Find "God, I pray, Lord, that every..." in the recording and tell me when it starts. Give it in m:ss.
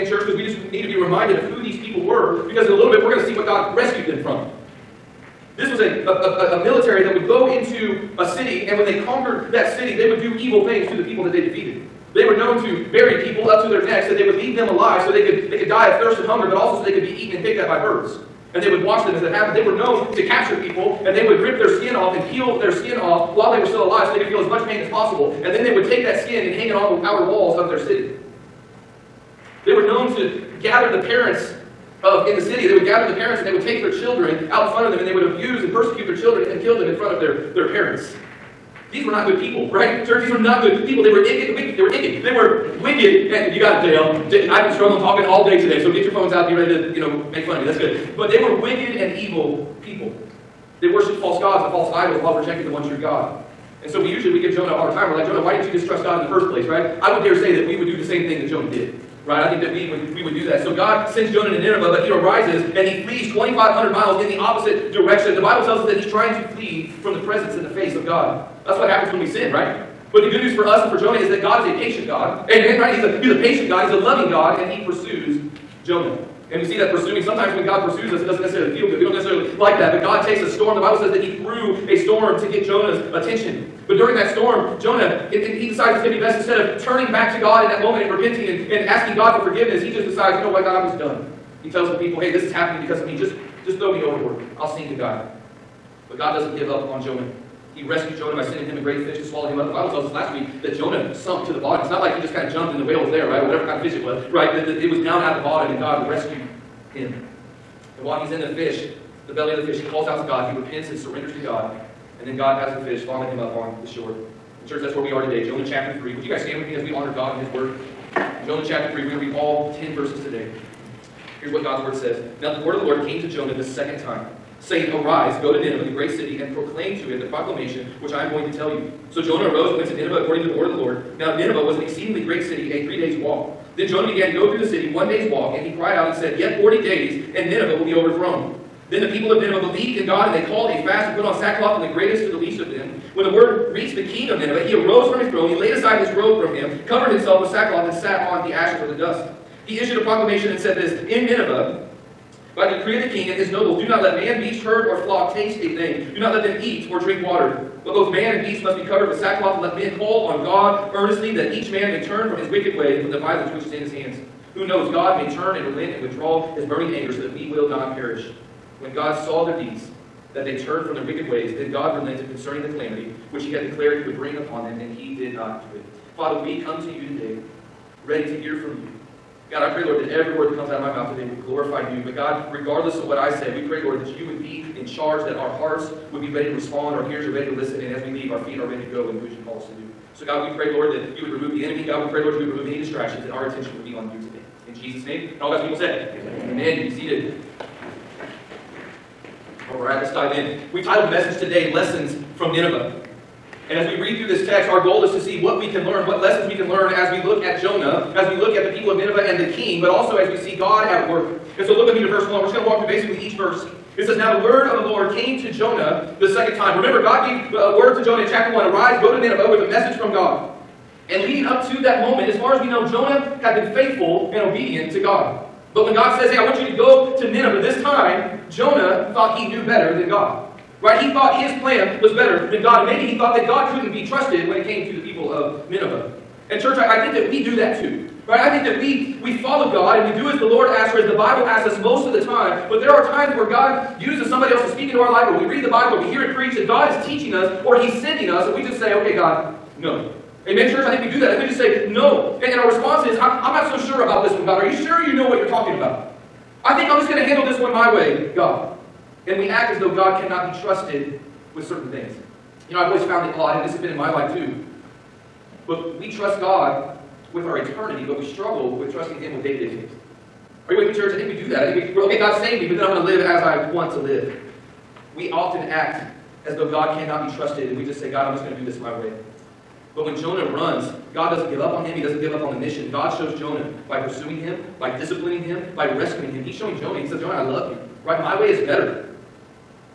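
2:59.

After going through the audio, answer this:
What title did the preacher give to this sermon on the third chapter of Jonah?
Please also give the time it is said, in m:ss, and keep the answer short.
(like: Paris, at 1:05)
Lessons from Nineveh, at 3:21.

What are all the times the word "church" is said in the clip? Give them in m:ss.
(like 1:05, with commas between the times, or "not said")
0:00, 0:40, 1:54, 3:56, 4:10, 4:30.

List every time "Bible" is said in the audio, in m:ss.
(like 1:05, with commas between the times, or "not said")
1:05, 1:20, 1:39, 4:01, 4:05.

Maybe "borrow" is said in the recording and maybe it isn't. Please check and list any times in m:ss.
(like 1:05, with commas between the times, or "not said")
not said.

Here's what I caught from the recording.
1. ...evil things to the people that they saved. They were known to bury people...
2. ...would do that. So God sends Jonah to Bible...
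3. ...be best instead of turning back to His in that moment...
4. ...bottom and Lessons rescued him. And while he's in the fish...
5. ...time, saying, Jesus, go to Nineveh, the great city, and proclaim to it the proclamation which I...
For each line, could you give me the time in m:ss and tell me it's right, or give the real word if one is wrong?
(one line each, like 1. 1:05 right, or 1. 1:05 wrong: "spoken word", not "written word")
1. 0:10 wrong: "defeated", not "saved"
2. 1:00 wrong: "Nineveh", not "Bible"
3. 1:26 wrong: "God", not "His"
4. 1:45 wrong: "God", not "Lessons"
5. 2:04 wrong: "Arise", not "Jesus".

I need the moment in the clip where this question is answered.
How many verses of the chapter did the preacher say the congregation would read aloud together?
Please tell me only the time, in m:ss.
1:59.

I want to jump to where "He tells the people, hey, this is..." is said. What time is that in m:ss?
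1:31.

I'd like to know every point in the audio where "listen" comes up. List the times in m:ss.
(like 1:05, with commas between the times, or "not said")
3:07.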